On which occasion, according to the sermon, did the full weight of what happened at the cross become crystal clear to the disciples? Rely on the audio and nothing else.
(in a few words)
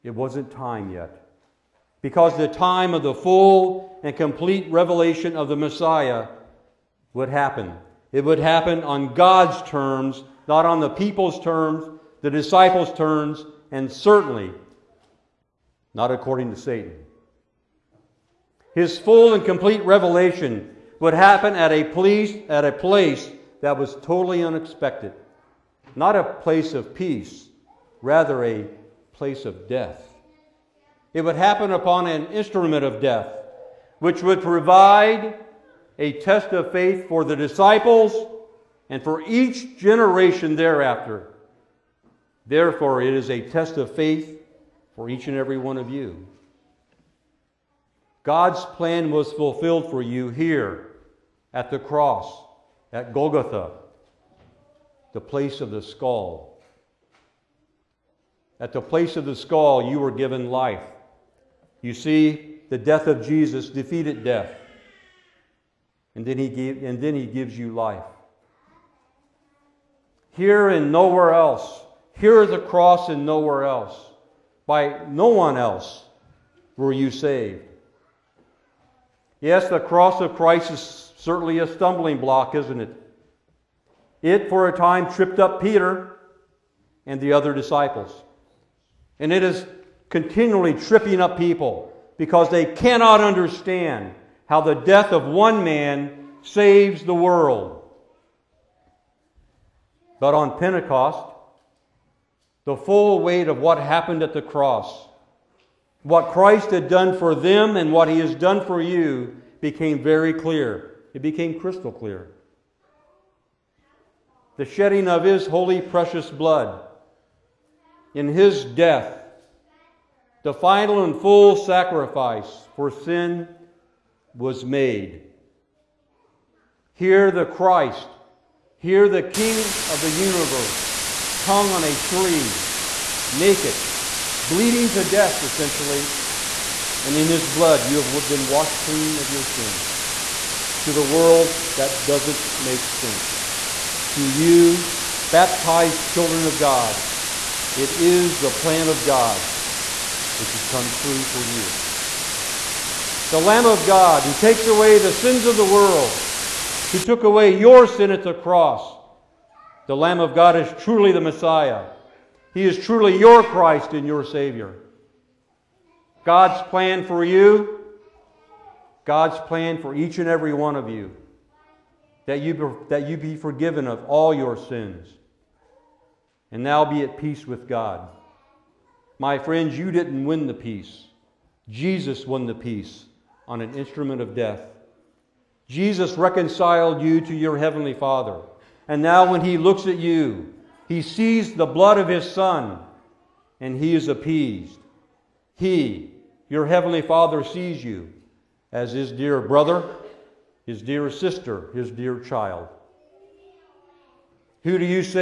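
Pentecost.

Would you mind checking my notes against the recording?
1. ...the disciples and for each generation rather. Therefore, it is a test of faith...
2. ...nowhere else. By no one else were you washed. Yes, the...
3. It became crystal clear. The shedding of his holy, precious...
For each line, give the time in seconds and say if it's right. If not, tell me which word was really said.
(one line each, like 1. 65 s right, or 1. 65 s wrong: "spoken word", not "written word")
1. 37 s wrong: "thereafter", not "rather"
2. 73 s wrong: "saved", not "washed"
3. 111 s right.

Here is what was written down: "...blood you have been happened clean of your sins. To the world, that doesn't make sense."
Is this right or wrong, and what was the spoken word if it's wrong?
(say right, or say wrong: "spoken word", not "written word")
wrong: "washed", not "happened".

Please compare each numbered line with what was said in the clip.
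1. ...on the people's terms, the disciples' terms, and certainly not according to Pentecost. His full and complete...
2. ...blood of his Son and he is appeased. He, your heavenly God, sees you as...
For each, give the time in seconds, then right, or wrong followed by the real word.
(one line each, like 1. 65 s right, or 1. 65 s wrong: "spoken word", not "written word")
1. 10 s wrong: "Satan", not "Pentecost"
2. 191 s wrong: "Father", not "God".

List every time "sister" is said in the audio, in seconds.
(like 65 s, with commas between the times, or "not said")
201 s.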